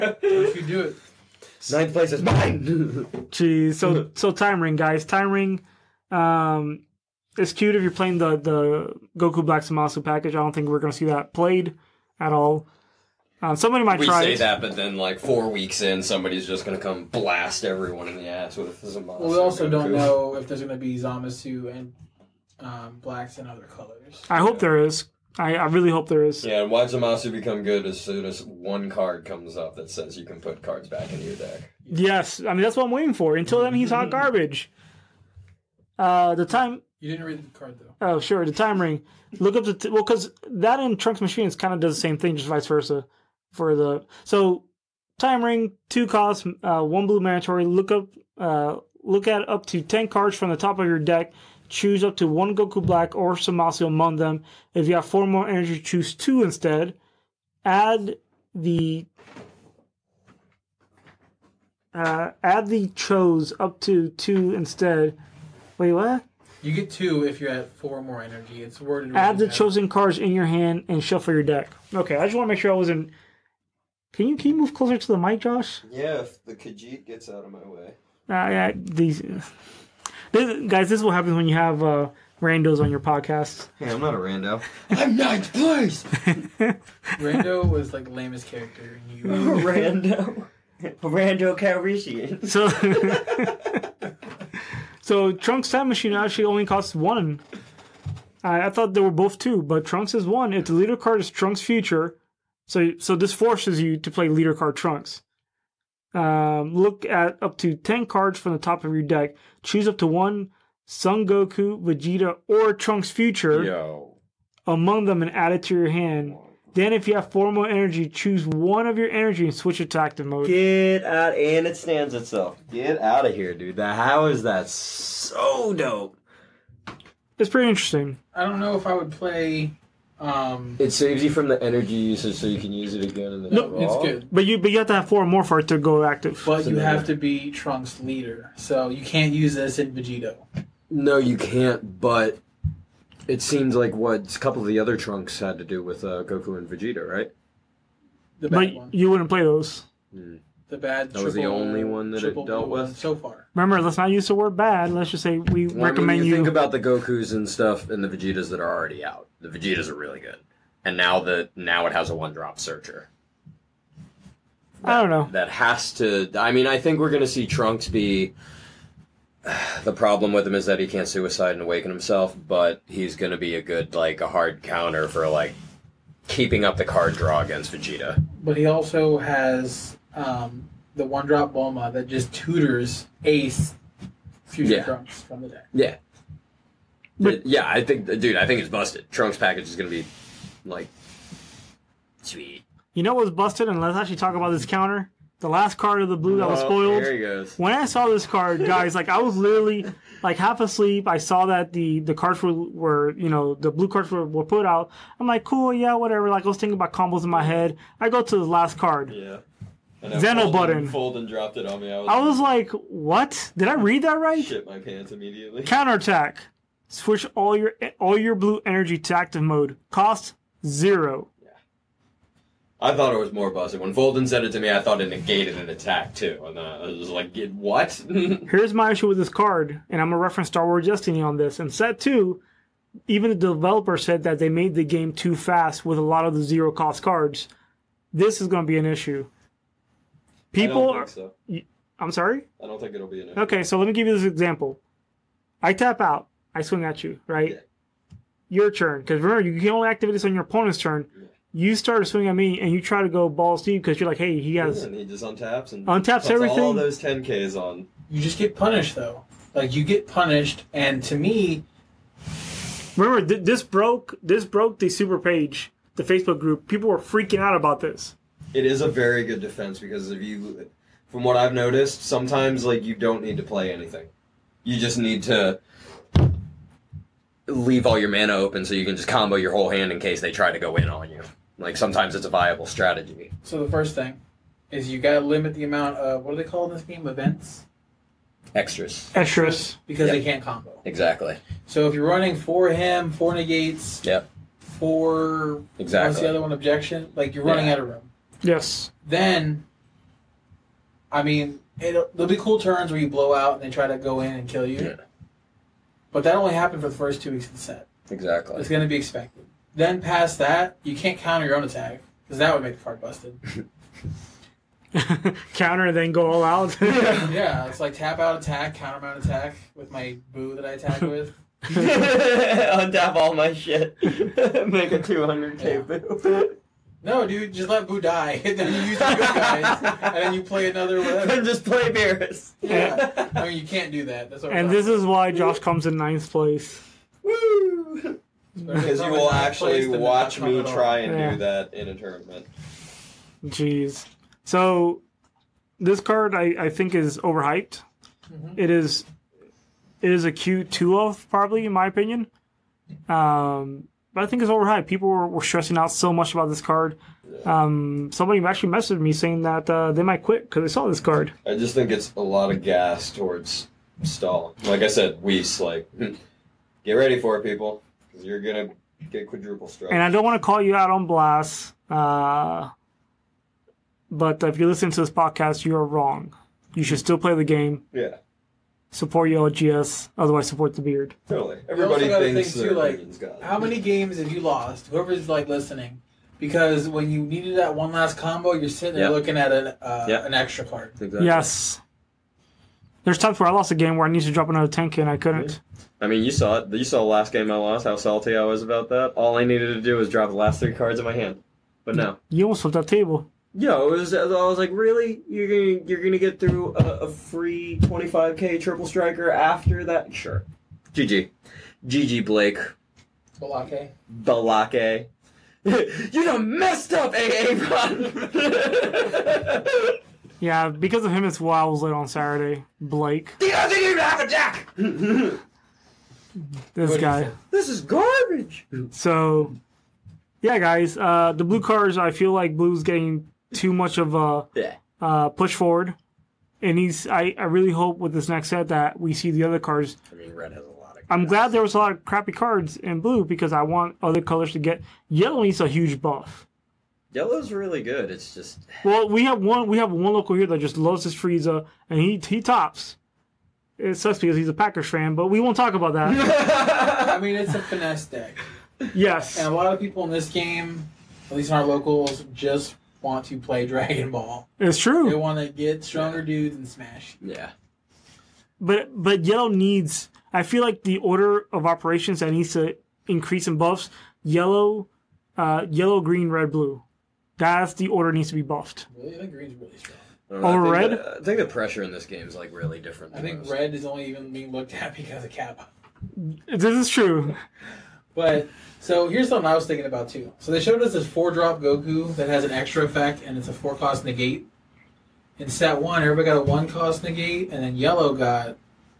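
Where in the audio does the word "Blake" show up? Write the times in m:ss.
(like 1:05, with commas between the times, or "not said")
6:52, 7:02.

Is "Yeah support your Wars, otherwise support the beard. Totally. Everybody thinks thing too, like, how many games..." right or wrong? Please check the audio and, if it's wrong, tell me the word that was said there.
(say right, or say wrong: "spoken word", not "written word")
wrong: "OGS", not "Wars".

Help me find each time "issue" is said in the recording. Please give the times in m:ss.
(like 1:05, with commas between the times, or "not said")
3:48, 3:58, 4:03.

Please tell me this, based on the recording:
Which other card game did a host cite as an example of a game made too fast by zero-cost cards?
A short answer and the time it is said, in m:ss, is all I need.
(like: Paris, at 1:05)
Star Wars Destiny, at 3:50.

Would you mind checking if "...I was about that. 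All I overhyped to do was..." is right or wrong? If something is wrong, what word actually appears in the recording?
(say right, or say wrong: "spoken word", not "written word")
wrong: "needed", not "overhyped".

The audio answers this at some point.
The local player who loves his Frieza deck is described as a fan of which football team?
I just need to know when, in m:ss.
7:34.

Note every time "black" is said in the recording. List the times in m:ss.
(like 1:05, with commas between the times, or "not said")
0:09, 0:23, 0:52.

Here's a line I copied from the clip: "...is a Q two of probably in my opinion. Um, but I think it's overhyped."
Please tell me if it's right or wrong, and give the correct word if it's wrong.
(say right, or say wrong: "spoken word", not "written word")
right.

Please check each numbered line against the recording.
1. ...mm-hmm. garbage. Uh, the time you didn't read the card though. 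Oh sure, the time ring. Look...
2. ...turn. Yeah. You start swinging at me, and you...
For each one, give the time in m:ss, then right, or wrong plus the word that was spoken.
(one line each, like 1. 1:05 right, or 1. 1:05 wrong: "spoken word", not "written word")
1. 0:34 right
2. 4:10 right.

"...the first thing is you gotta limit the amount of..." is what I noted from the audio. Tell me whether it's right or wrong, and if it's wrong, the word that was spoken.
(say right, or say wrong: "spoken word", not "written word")
right.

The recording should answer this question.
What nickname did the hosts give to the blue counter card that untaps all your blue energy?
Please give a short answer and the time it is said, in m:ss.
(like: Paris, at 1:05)
Zeno button, at 3:30.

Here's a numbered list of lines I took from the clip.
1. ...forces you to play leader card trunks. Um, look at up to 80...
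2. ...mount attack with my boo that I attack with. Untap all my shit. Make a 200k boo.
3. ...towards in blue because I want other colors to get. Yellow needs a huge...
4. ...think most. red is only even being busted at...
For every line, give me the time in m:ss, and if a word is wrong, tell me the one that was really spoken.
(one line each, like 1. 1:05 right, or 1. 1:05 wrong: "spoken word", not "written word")
1. 1:43 wrong: "10", not "80"
2. 5:18 right
3. 7:22 wrong: "cards", not "towards"
4. 8:03 wrong: "looked", not "busted".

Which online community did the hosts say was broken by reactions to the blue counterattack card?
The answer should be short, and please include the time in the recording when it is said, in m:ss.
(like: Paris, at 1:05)
the Facebook group, at 4:25.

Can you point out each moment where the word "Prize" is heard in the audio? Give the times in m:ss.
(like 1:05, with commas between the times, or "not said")
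not said.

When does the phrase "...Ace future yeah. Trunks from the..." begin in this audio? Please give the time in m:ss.
3:03.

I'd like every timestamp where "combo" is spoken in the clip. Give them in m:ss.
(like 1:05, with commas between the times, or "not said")
3:26, 4:39, 4:50, 6:28.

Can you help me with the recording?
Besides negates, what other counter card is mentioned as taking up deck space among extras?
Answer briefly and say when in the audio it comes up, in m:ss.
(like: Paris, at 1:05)
Objection, at 4:56.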